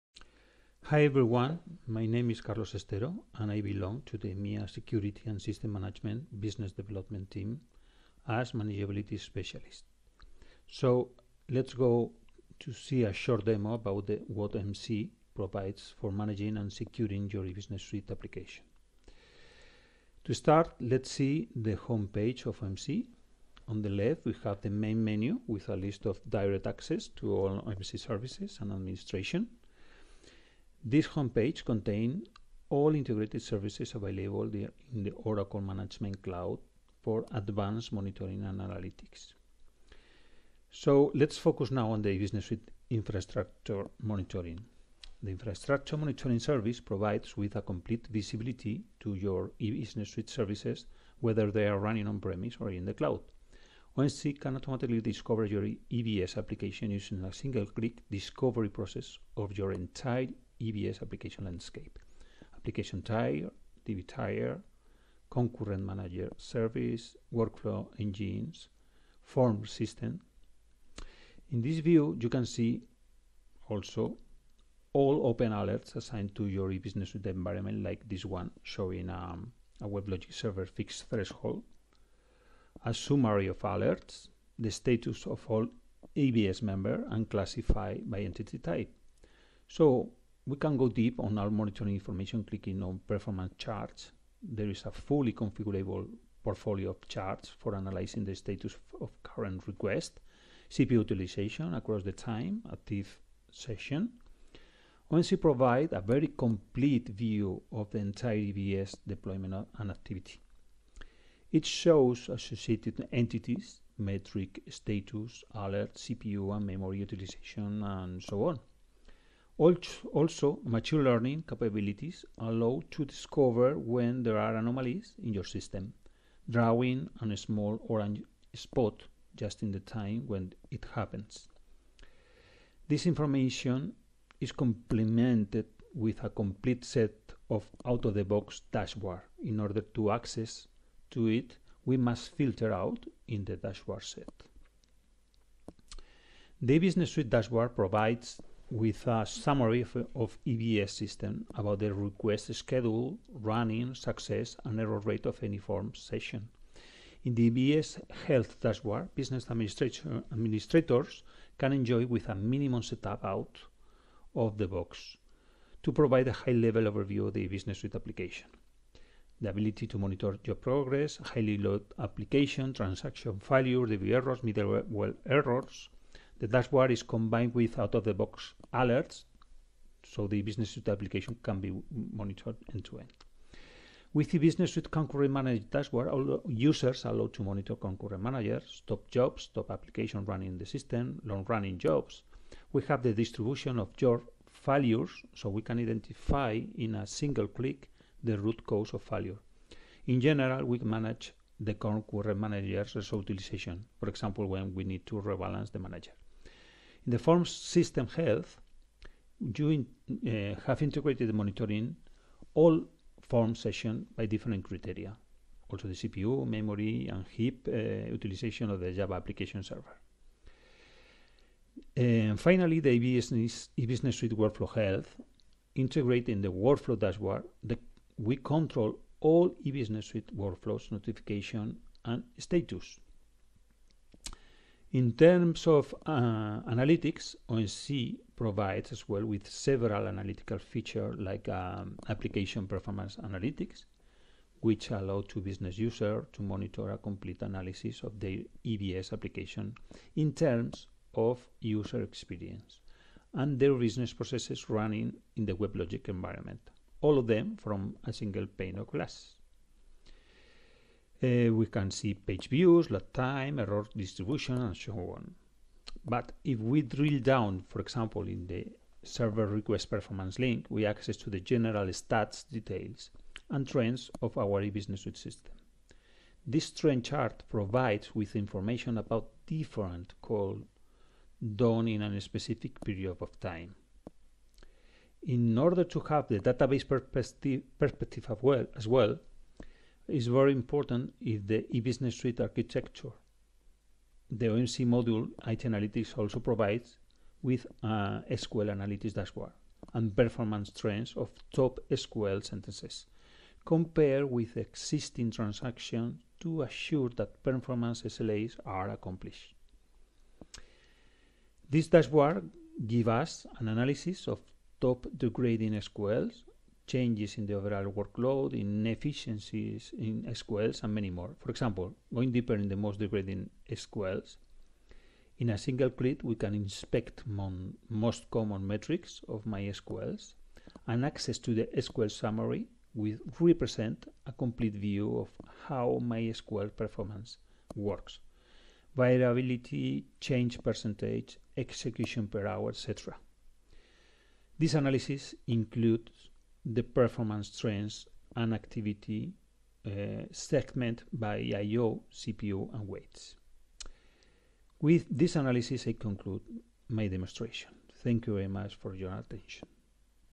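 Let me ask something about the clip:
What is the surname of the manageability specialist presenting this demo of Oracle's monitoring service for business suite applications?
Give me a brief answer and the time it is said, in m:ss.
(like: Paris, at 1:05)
Estero, at 0:02.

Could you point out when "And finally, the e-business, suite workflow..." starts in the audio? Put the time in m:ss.
3:41.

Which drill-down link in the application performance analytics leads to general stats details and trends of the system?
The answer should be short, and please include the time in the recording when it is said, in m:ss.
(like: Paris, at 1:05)
Server request performance, at 4:29.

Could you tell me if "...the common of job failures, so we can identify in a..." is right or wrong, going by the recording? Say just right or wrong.
wrong.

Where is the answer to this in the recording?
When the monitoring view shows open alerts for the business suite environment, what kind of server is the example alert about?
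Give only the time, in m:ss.
1:19.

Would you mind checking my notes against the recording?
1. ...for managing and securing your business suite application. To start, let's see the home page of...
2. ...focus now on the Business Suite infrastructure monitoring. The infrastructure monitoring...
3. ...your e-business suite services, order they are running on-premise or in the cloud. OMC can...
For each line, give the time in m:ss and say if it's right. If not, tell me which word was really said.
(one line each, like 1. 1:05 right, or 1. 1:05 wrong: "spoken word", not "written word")
1. 0:15 right
2. 0:41 right
3. 0:49 wrong: "whether", not "order".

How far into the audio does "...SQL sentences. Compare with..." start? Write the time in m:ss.
5:01.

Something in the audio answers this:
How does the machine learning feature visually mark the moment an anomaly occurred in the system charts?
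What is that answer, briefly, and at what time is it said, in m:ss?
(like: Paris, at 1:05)
Small orange spot, at 2:07.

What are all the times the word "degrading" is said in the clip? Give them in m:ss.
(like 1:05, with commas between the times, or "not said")
5:15, 5:22.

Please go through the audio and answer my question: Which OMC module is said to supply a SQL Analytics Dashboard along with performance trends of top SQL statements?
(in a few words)
IT Analytics.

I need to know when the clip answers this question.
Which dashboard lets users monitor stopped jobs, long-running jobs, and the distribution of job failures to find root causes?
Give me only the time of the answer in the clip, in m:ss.
3:04.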